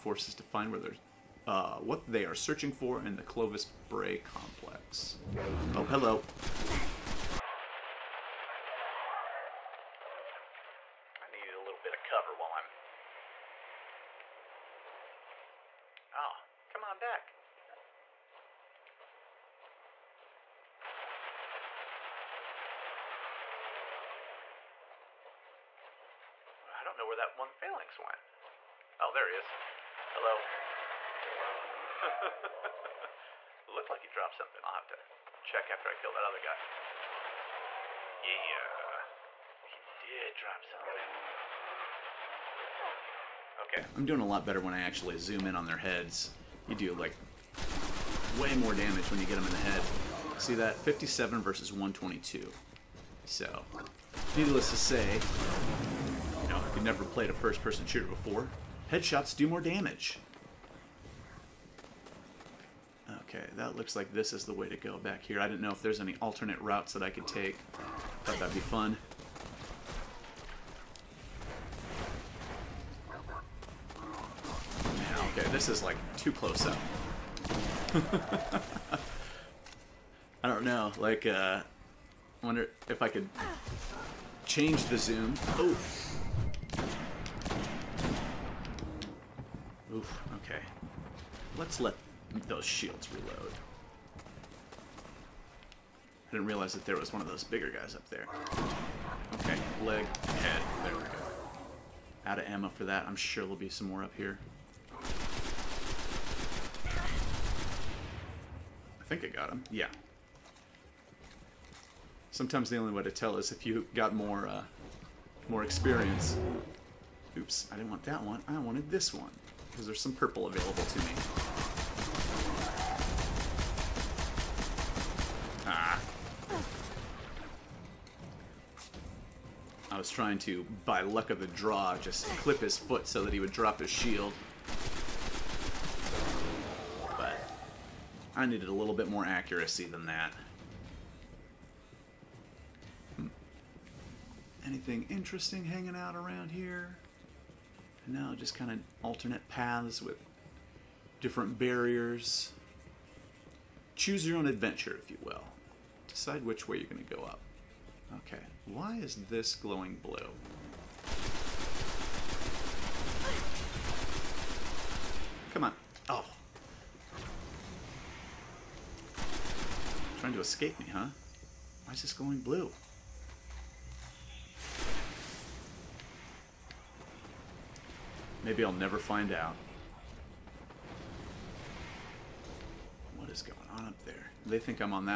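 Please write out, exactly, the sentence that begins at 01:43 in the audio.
I'm sure there'll be some more up here.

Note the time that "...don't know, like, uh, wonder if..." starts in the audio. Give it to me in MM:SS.
01:20.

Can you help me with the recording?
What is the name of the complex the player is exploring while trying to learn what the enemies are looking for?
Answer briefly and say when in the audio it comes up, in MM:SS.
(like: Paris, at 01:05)
Clovis Bray complex, at 00:03.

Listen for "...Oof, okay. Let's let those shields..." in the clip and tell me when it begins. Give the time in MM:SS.
01:29.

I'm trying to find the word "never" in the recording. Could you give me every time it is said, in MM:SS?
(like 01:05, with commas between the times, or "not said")
00:56, 02:58.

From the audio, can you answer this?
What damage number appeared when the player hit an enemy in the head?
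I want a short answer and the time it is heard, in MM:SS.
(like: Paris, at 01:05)
122, at 00:51.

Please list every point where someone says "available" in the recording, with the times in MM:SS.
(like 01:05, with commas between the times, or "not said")
02:00.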